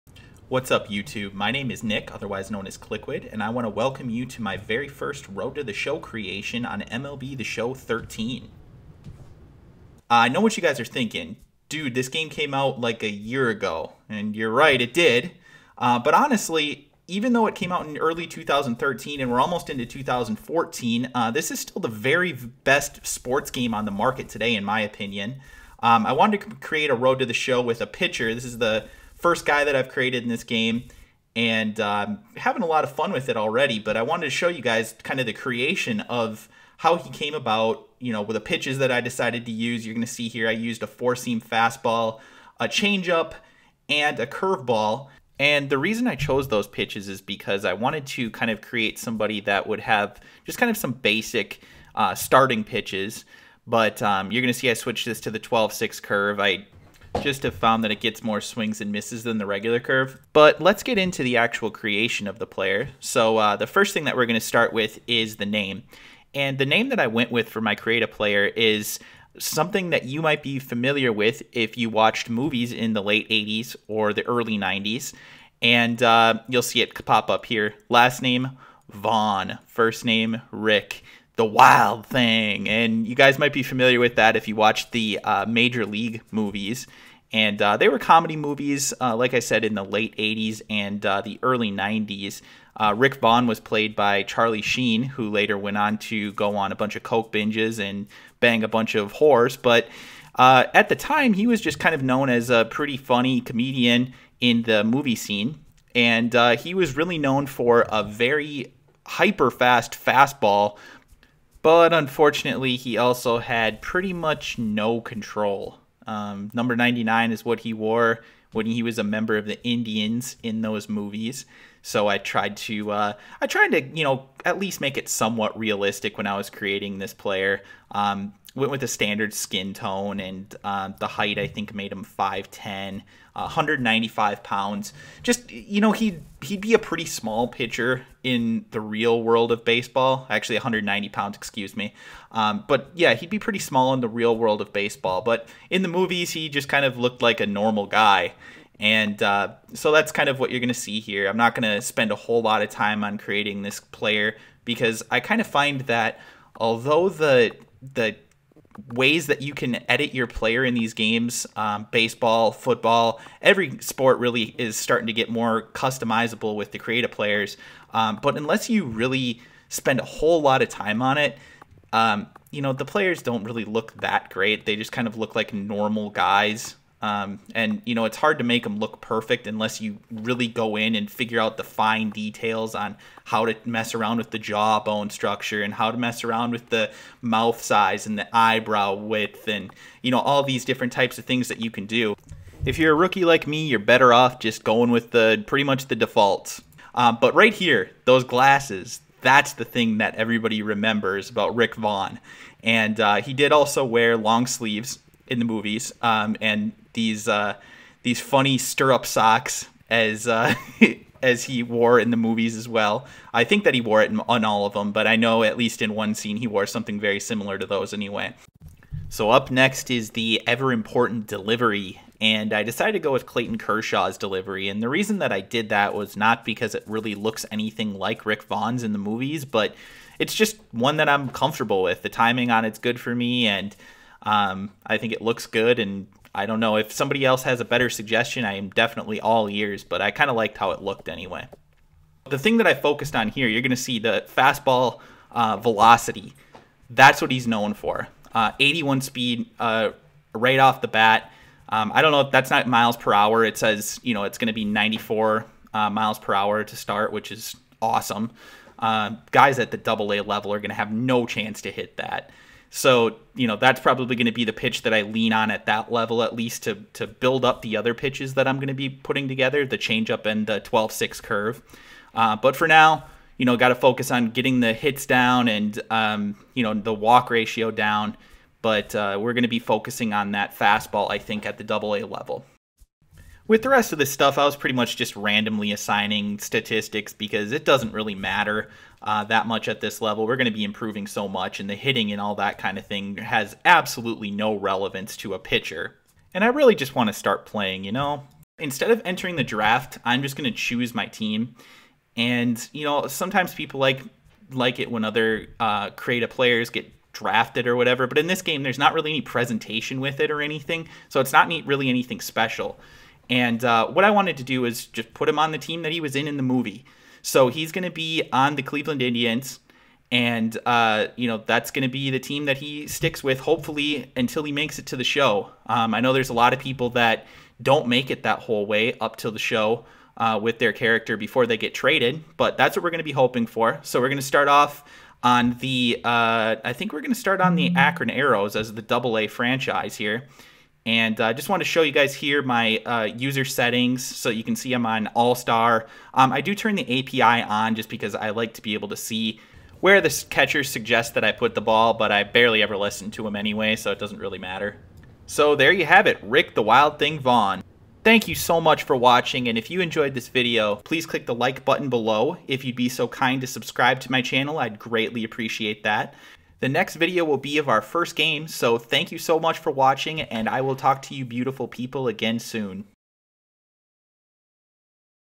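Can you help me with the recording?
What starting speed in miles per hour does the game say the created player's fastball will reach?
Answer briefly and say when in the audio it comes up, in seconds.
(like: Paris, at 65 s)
94, at 254 s.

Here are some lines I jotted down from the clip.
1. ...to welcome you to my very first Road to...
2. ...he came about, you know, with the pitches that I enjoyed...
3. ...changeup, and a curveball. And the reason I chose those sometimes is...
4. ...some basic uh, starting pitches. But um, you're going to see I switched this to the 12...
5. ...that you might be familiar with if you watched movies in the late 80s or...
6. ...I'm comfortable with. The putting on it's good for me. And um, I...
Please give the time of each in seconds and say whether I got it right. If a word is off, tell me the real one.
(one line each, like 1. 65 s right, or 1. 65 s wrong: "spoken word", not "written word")
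1. 3 s right
2. 36 s wrong: "decided", not "enjoyed"
3. 42 s wrong: "pitches", not "sometimes"
4. 50 s right
5. 69 s right
6. 231 s wrong: "timing", not "putting".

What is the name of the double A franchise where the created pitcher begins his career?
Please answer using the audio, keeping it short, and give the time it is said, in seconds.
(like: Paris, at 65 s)
Akron Aeros, at 337 s.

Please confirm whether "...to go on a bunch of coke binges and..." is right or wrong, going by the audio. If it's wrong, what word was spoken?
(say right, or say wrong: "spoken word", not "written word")
right.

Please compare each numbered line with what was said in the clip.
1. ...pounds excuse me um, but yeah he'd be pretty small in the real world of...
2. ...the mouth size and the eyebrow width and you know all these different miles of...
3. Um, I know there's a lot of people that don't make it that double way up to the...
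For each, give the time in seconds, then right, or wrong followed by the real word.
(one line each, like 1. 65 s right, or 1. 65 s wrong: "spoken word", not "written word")
1. 141 s right
2. 186 s wrong: "types", not "miles"
3. 325 s wrong: "whole", not "double".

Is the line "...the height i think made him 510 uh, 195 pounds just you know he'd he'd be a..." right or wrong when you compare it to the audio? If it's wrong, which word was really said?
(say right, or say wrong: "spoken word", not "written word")
right.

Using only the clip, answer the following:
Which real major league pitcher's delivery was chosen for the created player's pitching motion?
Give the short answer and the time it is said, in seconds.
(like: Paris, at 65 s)
Clayton Kershaw, at 223 s.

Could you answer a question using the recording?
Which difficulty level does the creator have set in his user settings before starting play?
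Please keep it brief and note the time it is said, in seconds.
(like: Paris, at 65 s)
All-Star, at 345 s.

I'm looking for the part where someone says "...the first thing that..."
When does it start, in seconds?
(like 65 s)
63 s.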